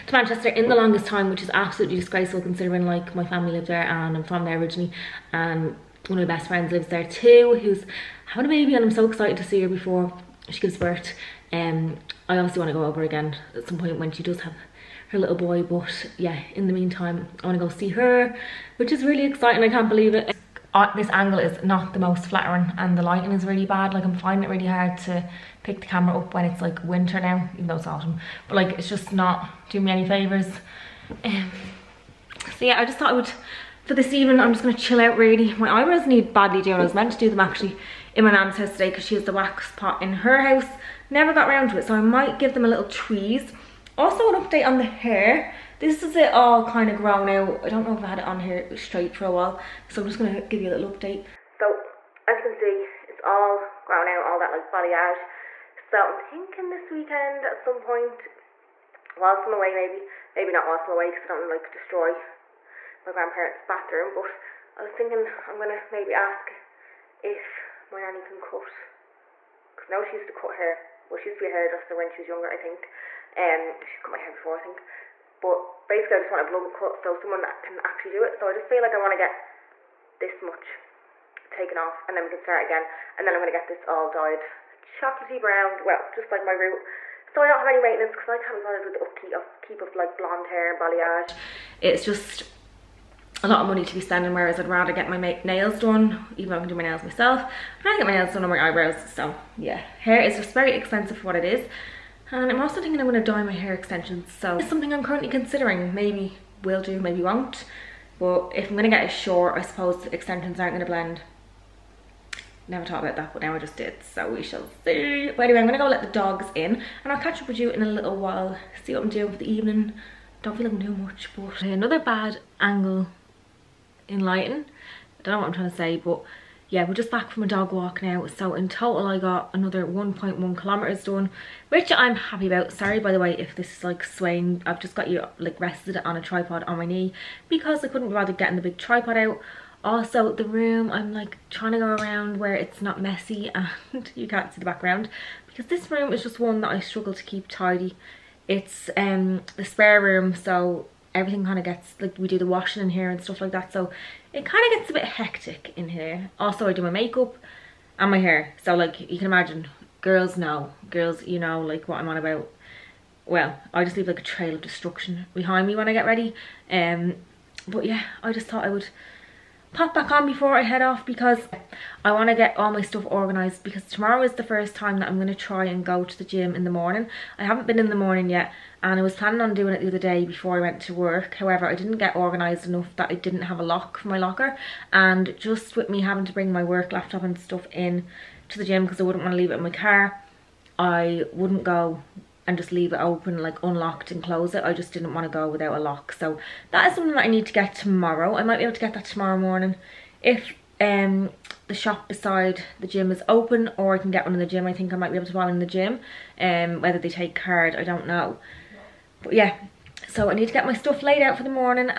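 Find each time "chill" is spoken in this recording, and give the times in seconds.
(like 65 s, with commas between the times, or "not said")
34 s.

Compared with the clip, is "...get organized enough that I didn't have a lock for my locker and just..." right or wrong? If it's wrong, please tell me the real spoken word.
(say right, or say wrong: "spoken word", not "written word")
right.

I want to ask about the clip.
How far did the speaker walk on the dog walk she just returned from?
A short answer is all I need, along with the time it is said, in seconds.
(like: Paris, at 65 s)
1.1 kilometers, at 129 s.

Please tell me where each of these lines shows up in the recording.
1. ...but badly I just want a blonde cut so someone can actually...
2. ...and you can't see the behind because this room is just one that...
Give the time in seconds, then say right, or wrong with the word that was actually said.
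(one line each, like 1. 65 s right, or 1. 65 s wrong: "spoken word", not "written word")
1. 75 s wrong: "basically", not "badly"
2. 143 s wrong: "background", not "behind".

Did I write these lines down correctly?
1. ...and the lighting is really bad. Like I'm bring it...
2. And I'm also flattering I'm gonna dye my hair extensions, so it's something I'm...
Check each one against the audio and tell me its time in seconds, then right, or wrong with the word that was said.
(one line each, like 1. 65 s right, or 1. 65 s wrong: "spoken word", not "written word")
1. 22 s wrong: "finding", not "bring"
2. 102 s wrong: "thinking", not "flattering".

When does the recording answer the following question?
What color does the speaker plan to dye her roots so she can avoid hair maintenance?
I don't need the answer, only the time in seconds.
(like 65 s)
84 s.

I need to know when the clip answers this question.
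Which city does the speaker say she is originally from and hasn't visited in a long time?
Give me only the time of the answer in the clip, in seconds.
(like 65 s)
0 s.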